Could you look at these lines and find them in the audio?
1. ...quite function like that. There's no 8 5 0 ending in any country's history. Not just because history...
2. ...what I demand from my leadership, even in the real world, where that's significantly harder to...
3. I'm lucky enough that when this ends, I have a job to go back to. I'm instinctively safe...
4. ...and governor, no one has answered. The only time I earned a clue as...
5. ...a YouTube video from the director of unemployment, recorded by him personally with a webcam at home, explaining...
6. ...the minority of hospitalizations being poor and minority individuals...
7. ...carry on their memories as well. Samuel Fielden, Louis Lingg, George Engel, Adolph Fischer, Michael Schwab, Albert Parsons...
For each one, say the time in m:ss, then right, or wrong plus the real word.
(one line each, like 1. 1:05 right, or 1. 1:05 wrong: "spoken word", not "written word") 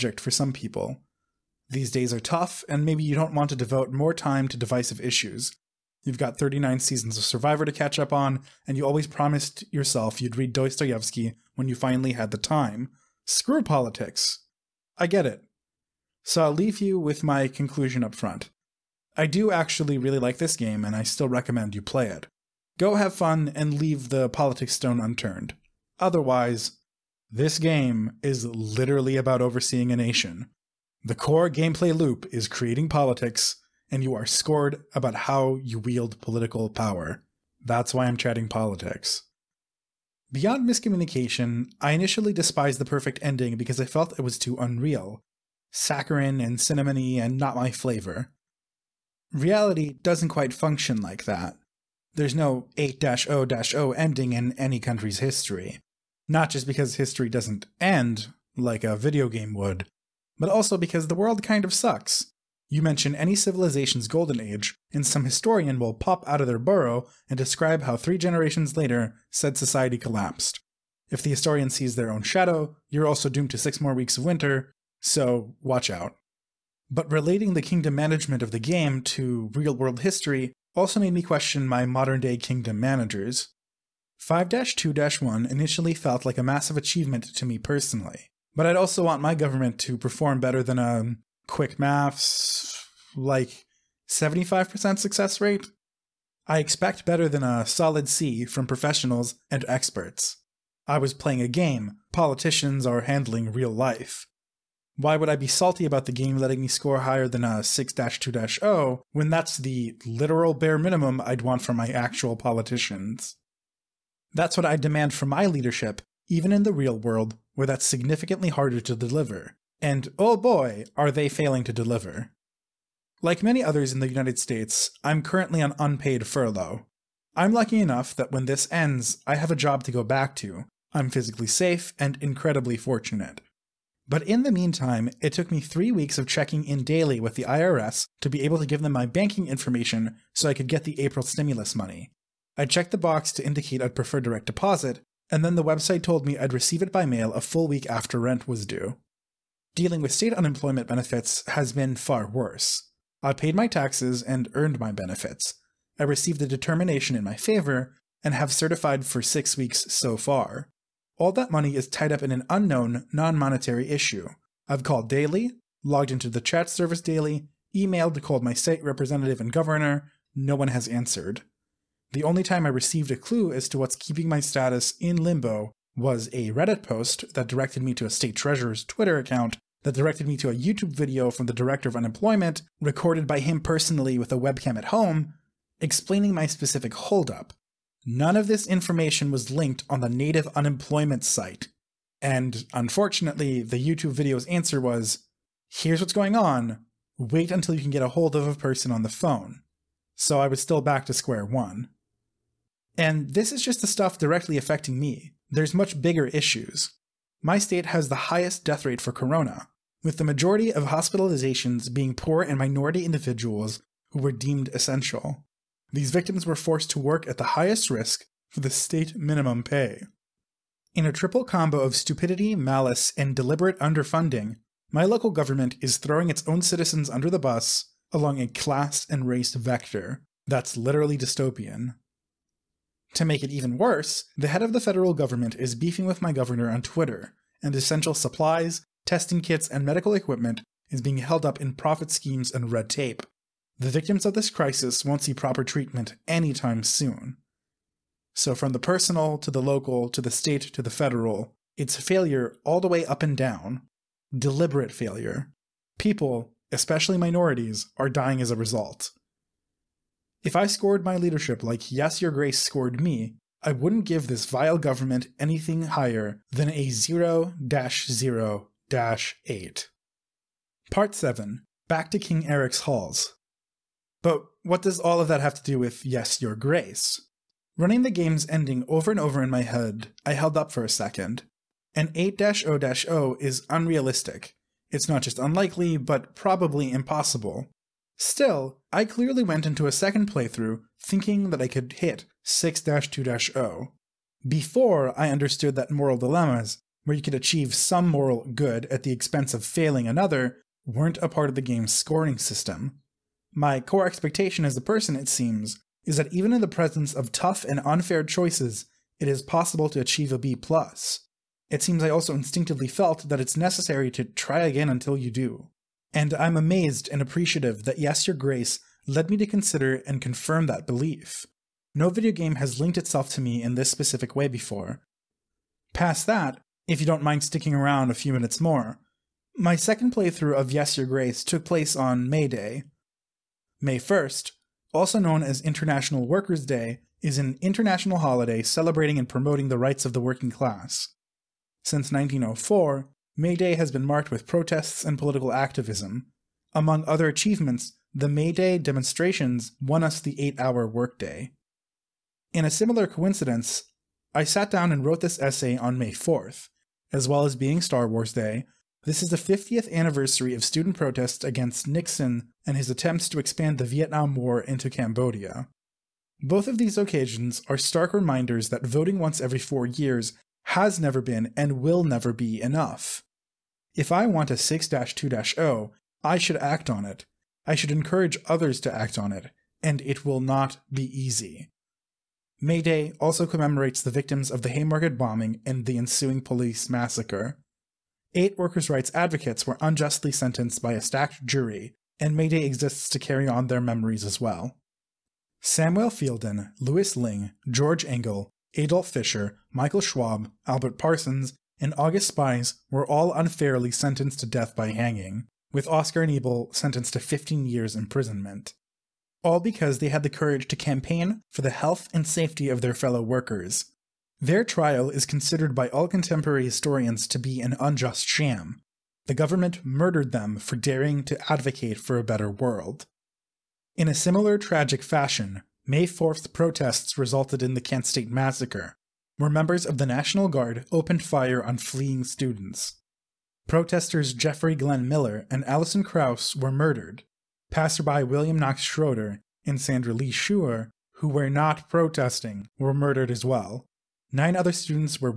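1. 0:50 wrong: "0", not "5"
2. 1:54 right
3. 2:07 wrong: "physically", not "instinctively"
4. 2:49 wrong: "received", not "earned"
5. 3:00 right
6. 3:30 wrong: "majority", not "minority"
7. 6:33 right.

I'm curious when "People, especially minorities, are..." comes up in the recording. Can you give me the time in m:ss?
4:15.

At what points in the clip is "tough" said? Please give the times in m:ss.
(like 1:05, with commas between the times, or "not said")
0:02, 5:07.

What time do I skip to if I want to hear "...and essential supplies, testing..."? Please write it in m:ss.
3:57.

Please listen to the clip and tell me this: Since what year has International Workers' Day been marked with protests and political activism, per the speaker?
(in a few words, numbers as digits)
1904.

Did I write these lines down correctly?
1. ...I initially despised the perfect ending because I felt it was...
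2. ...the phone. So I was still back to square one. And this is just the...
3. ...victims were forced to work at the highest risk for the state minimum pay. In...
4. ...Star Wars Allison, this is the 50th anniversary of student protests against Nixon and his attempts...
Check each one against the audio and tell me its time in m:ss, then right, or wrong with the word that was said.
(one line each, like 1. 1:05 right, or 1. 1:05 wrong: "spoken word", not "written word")
1. 0:41 right
2. 3:19 right
3. 3:36 right
4. 5:57 wrong: "Day", not "Allison".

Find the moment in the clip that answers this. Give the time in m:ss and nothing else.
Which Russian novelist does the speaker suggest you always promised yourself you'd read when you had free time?
0:10.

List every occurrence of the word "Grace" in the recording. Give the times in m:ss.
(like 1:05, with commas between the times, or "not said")
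4:22, 4:36, 5:18, 5:31.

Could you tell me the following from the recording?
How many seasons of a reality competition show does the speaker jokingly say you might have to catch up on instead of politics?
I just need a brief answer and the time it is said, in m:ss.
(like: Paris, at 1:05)
39, at 0:06.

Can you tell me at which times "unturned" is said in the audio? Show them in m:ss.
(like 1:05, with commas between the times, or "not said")
0:25.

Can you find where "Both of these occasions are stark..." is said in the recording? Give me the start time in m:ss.
6:06.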